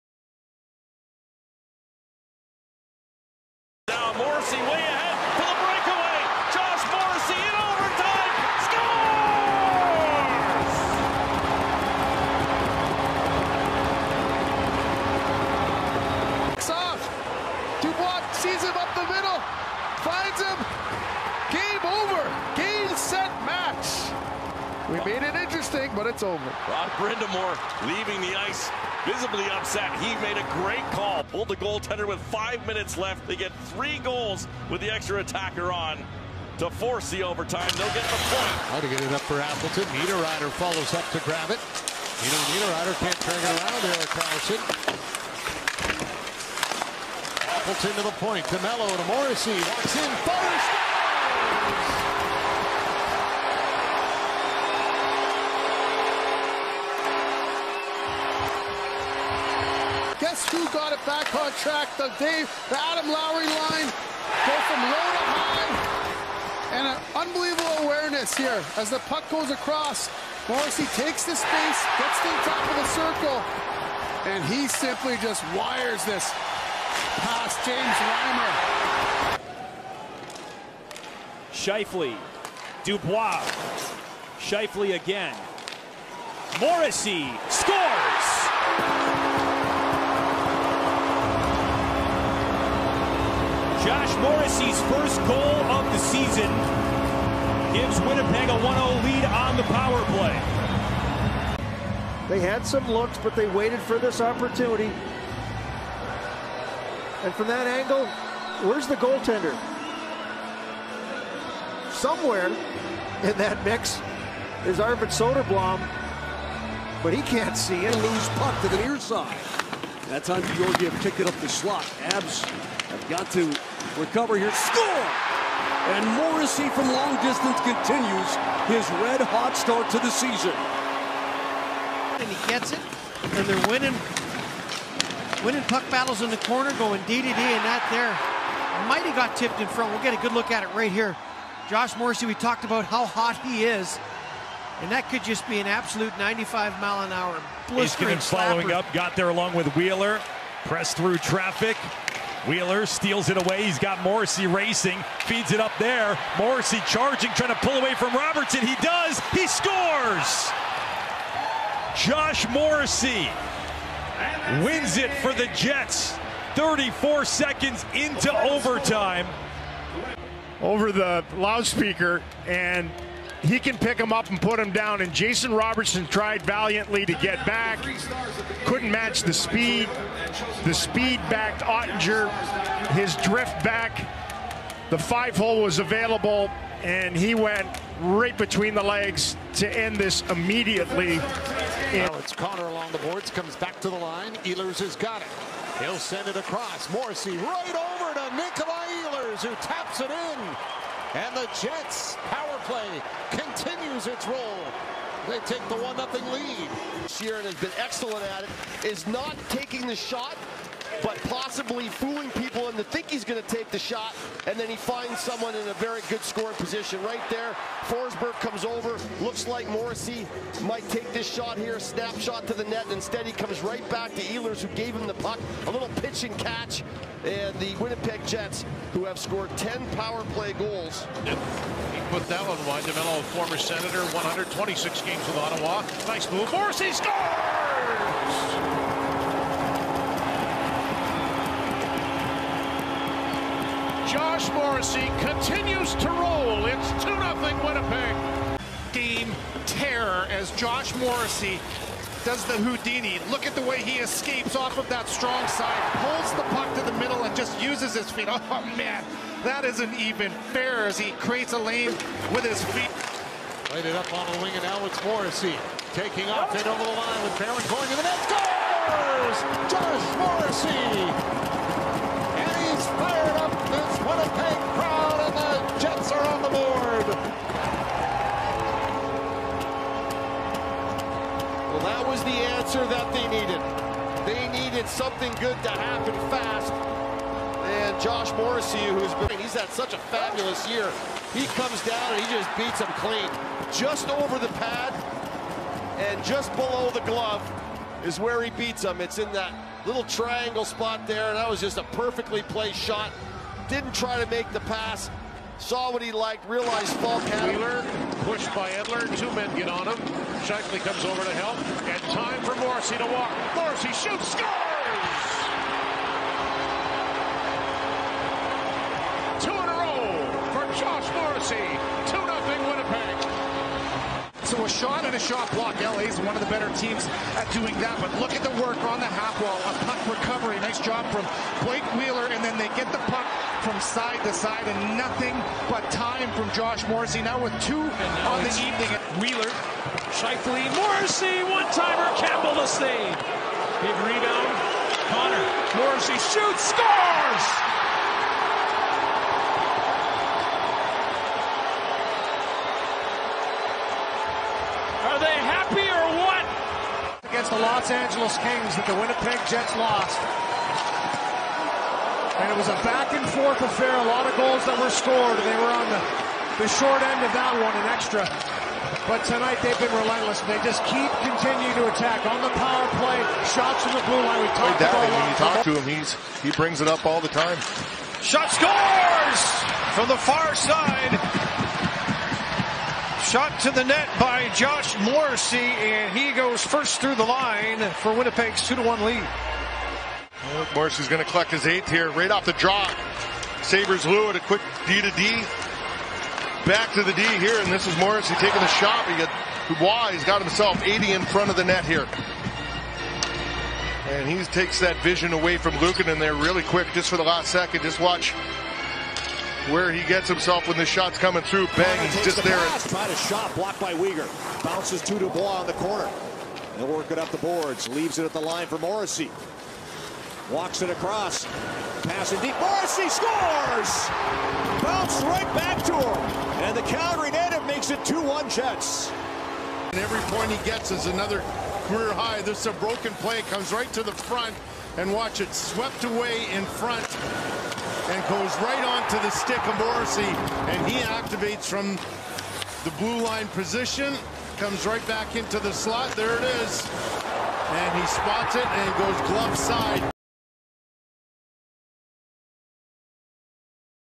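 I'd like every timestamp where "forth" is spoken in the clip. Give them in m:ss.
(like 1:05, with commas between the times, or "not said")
6:02.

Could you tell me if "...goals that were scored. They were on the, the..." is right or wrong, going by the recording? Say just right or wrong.
right.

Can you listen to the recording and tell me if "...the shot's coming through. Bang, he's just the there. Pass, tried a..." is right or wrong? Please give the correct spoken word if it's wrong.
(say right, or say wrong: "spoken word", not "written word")
right.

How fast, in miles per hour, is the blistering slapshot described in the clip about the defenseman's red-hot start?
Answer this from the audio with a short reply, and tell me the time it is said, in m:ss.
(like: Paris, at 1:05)
95, at 2:26.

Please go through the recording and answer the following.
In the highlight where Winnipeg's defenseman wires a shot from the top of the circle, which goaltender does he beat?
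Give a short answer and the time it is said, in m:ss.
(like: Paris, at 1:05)
James Reimer, at 1:17.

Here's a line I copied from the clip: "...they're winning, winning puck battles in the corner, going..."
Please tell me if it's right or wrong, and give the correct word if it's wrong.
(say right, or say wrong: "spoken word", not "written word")
right.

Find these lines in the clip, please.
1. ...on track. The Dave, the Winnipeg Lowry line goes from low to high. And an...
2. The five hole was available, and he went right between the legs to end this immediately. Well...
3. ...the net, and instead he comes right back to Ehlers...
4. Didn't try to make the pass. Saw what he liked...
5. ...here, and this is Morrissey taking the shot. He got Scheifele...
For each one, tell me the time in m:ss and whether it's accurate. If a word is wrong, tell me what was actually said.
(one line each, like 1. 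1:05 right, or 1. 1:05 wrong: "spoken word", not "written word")
1. 1:01 wrong: "Adam", not "Winnipeg"
2. 3:04 right
3. 3:42 right
4. 5:03 right
5. 6:37 wrong: "Dubois", not "Scheifele".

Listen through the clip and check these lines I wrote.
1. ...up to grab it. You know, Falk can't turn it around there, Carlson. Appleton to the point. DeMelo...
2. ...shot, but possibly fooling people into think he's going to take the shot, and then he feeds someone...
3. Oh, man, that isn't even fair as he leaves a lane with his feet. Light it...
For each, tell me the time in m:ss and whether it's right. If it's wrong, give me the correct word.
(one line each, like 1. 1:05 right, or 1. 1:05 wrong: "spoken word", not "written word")
1. 0:40 wrong: "Niederreiter", not "Falk"
2. 3:29 wrong: "finds", not "feeds"
3. 4:18 wrong: "creates", not "leaves".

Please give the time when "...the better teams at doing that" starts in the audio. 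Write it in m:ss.
5:26.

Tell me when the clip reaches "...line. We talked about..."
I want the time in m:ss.
6:14.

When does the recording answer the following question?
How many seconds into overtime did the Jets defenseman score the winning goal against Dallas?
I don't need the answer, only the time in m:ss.
2:46.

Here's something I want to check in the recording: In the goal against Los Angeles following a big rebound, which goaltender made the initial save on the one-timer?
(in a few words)
Campbell.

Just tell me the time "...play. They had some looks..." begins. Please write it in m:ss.
1:40.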